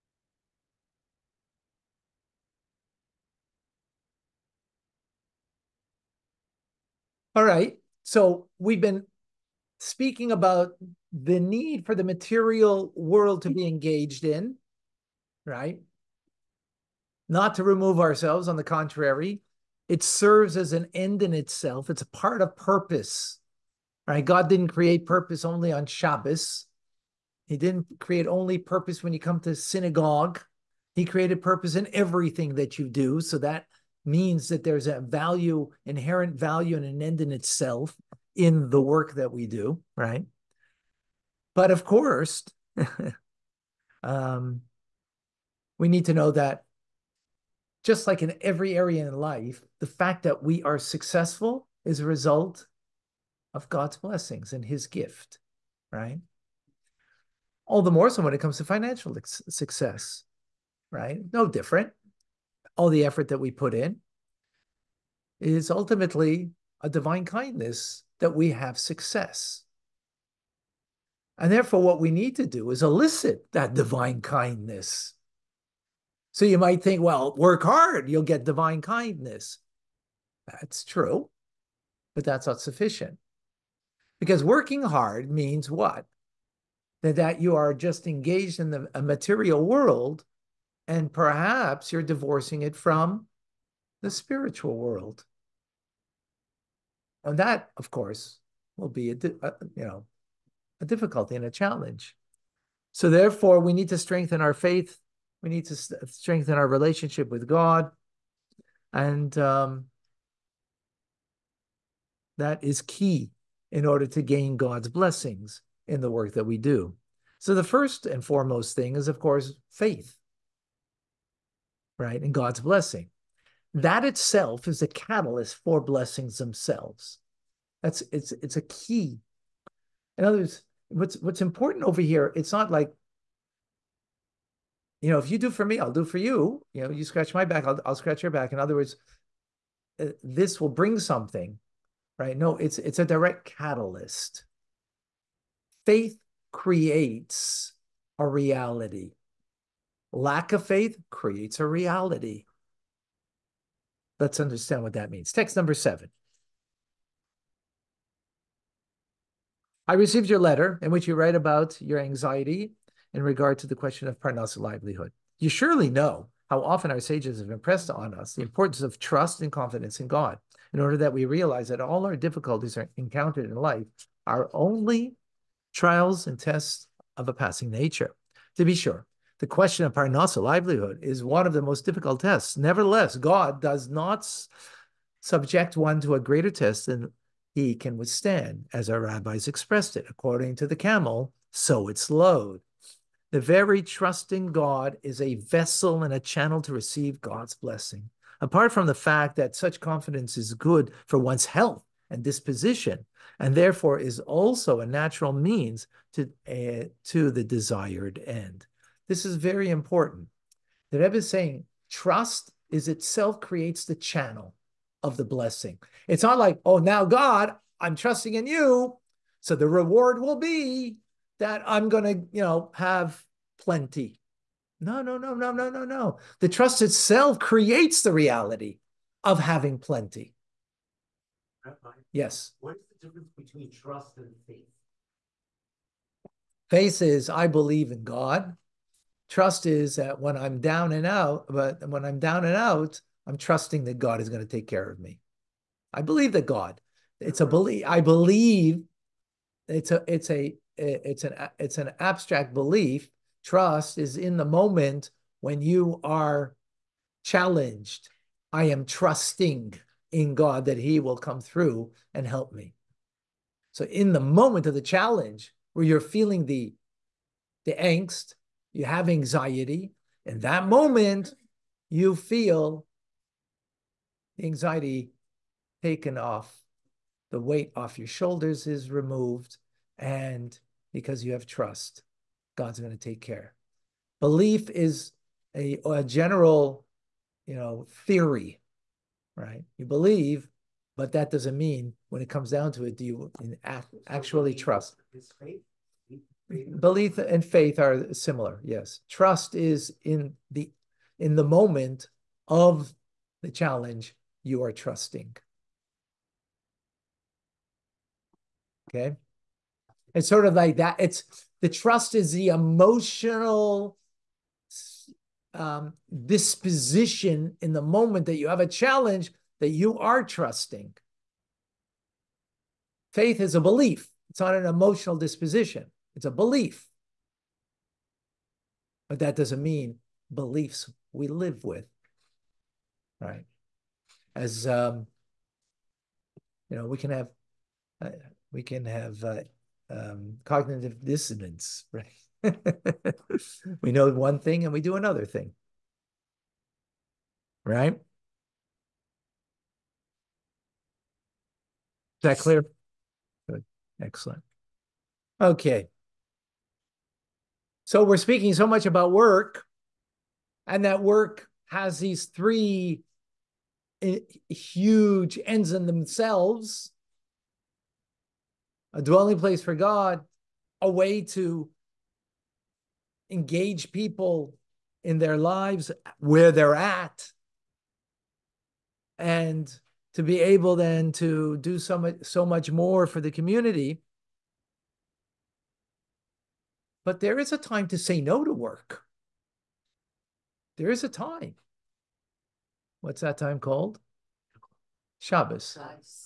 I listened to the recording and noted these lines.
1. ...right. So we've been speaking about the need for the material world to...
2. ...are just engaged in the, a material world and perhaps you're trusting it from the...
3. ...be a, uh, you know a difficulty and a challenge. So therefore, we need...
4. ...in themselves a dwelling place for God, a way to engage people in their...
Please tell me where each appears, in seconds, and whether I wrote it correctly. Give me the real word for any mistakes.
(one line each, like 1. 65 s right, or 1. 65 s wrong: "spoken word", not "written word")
1. 7 s right
2. 87 s wrong: "divorcing", not "trusting"
3. 98 s right
4. 365 s right.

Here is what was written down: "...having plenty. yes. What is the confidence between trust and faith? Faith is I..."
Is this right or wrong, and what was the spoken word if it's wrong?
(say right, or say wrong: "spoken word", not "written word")
wrong: "difference", not "confidence".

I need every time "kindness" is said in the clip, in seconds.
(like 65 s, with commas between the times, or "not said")
67 s, 74 s, 78 s.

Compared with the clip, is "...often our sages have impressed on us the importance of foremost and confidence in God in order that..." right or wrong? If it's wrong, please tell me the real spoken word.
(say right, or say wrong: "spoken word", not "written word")
wrong: "trust", not "foremost".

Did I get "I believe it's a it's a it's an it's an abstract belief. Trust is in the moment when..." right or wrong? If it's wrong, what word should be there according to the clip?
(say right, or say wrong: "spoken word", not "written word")
right.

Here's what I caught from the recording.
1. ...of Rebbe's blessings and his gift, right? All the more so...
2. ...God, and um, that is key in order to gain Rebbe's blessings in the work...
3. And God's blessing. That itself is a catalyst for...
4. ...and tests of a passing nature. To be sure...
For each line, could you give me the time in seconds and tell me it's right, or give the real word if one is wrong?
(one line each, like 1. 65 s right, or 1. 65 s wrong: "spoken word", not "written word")
1. 53 s wrong: "God", not "Rebbe"
2. 107 s wrong: "God", not "Rebbe"
3. 122 s right
4. 176 s right.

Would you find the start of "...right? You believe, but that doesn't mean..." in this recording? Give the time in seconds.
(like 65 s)
289 s.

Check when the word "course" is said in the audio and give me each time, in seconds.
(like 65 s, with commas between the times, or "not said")
41 s, 97 s, 119 s.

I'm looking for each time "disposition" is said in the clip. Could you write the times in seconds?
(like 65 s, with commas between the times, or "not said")
202 s, 316 s, 325 s.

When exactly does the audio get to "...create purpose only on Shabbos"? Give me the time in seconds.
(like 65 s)
24 s.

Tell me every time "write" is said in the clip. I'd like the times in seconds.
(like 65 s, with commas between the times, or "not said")
161 s.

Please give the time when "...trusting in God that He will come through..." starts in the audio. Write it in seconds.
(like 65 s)
258 s.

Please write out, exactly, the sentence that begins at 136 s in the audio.
You know, you scratch my back, I'll, I'll scratch your back.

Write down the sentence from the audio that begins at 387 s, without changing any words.
But there is a time to say no to work.